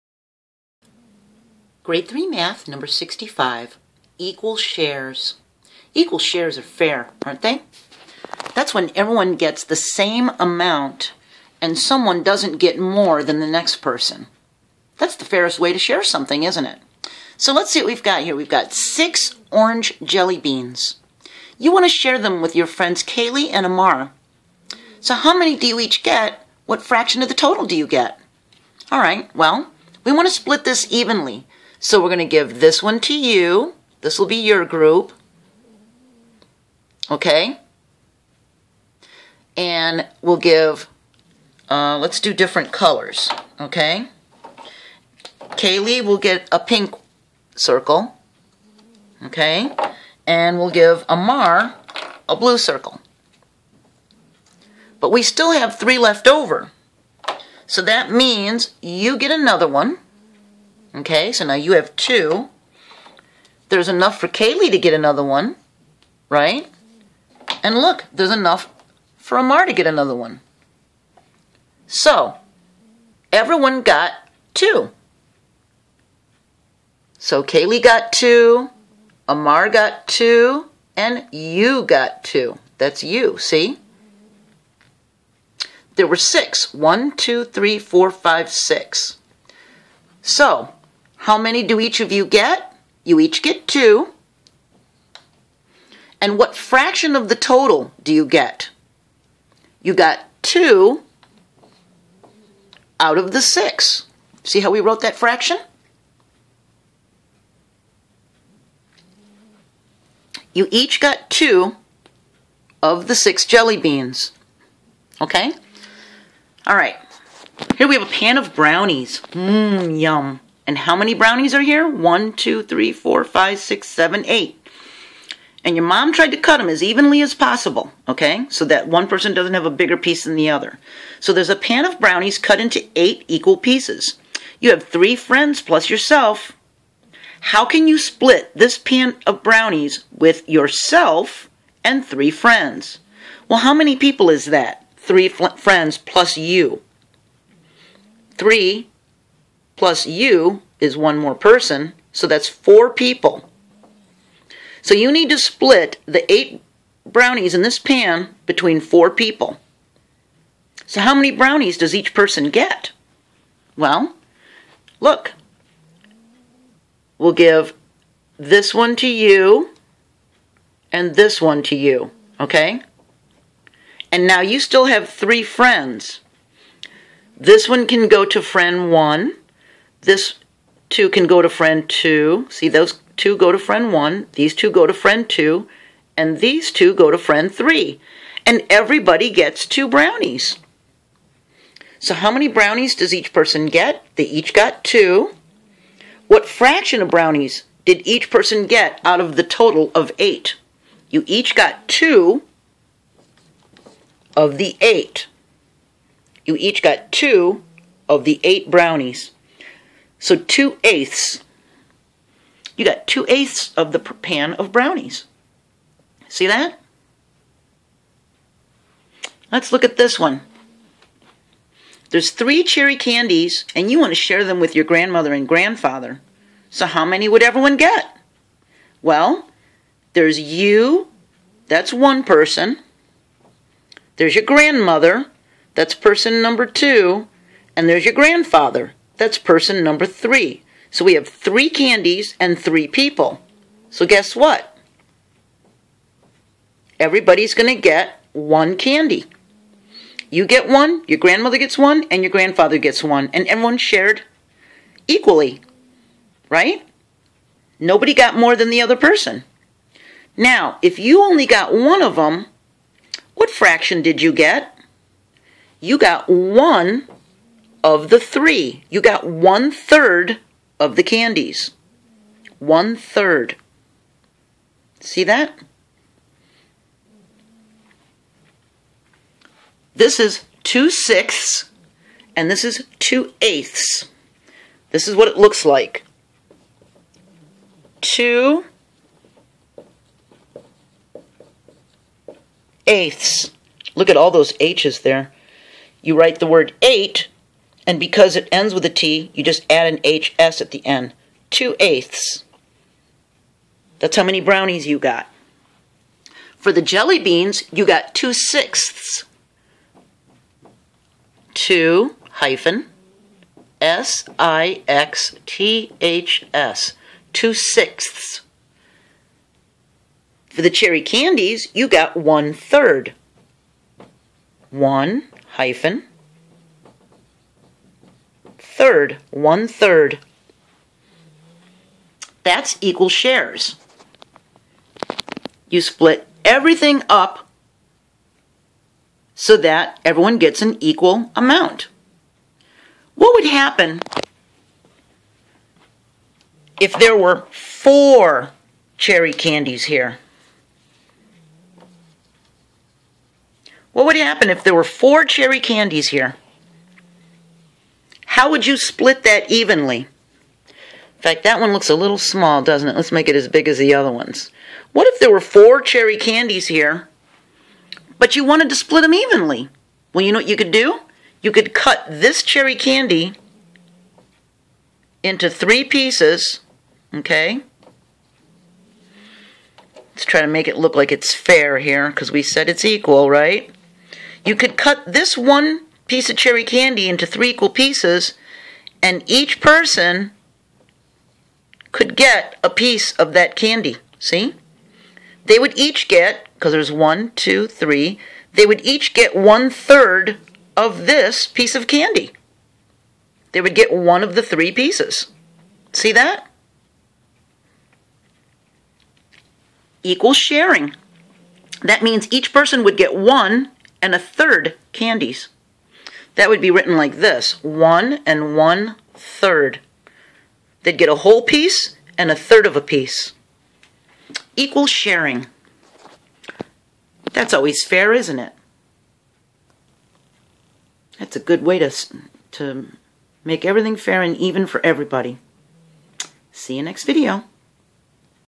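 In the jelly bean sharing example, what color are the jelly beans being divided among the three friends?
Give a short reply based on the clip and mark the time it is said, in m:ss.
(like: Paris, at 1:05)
orange, at 0:19.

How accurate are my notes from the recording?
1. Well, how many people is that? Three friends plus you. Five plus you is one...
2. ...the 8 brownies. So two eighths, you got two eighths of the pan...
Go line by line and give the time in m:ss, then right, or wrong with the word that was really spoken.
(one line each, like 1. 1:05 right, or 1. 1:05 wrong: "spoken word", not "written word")
1. 2:23 wrong: "Three", not "Five"
2. 3:28 right.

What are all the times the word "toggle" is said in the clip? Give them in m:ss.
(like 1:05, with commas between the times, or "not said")
not said.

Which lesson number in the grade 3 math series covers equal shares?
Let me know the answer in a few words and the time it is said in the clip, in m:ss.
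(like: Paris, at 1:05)
65, at 0:02.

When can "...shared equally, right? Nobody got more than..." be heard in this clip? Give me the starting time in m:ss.
4:13.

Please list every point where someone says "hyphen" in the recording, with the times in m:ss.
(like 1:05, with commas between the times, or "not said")
5:12, 5:25.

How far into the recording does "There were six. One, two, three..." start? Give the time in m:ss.
1:25.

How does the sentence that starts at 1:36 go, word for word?
And what fraction of the total do you get?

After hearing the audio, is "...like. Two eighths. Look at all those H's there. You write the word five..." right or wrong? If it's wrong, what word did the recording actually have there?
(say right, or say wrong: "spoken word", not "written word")
wrong: "eight", not "five".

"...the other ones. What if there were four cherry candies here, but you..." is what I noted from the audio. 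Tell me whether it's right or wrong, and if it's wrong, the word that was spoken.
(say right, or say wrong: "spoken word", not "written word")
right.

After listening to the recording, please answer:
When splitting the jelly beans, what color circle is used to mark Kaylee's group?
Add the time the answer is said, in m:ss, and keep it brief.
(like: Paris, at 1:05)
pink, at 0:46.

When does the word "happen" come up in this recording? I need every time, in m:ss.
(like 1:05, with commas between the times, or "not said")
5:43, 5:54.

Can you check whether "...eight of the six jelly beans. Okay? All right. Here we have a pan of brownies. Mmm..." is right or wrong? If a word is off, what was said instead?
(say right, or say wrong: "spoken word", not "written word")
wrong: "two", not "eight".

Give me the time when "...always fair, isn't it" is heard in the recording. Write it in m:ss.
7:07.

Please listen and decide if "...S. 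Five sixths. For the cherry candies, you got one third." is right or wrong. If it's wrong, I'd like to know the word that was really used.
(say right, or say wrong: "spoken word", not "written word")
wrong: "Two", not "Five".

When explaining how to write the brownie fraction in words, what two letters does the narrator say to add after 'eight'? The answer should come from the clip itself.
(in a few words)
HS.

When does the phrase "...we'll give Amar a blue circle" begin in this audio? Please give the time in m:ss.
0:50.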